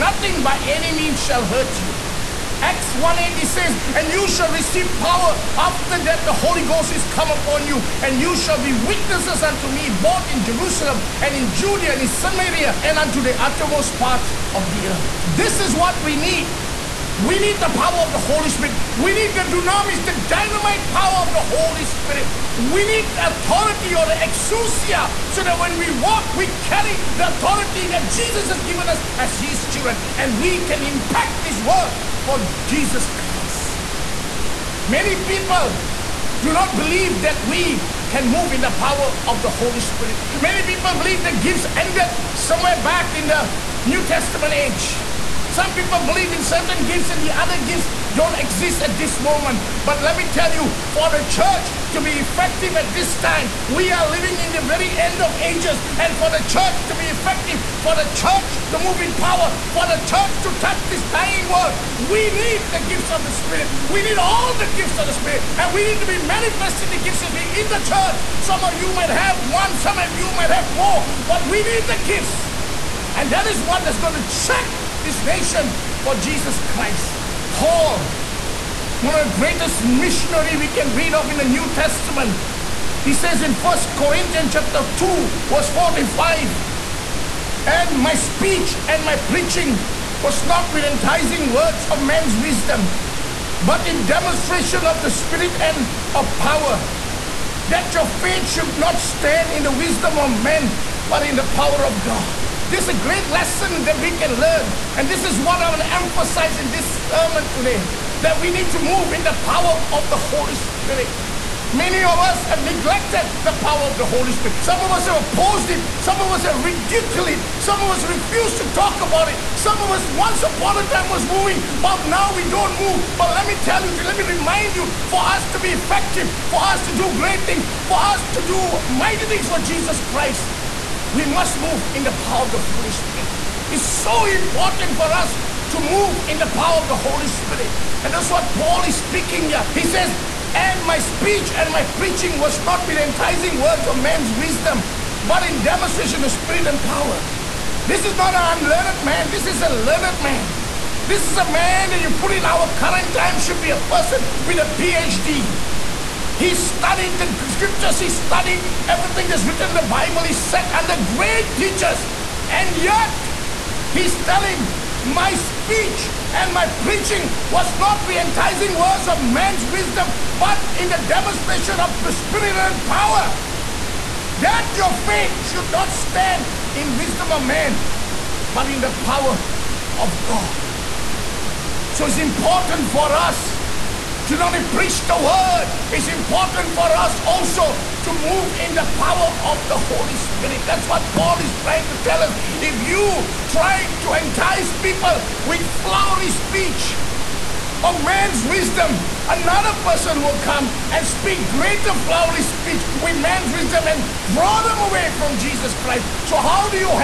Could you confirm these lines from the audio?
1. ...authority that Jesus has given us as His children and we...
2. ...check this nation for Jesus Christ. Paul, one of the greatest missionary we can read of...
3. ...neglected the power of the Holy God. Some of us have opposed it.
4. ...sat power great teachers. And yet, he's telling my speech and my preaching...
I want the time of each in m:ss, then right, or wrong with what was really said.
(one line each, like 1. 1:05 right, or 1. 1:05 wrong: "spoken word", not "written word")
1. 0:27 right
2. 1:14 right
3. 1:52 wrong: "Spirit", not "God"
4. 2:40 wrong: "under", not "power".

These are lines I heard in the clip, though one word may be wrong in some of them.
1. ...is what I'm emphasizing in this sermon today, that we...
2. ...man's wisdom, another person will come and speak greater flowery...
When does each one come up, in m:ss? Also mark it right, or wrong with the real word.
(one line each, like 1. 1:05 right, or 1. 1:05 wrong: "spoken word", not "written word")
1. 1:45 right
2. 3:18 right.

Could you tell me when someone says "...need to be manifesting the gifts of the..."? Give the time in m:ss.
1:05.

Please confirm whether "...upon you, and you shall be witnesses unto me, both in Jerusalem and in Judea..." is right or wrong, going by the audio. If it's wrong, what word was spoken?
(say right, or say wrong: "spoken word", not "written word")
right.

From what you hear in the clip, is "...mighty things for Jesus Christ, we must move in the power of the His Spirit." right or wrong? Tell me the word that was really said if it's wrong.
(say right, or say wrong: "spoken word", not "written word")
wrong: "Holy", not "His".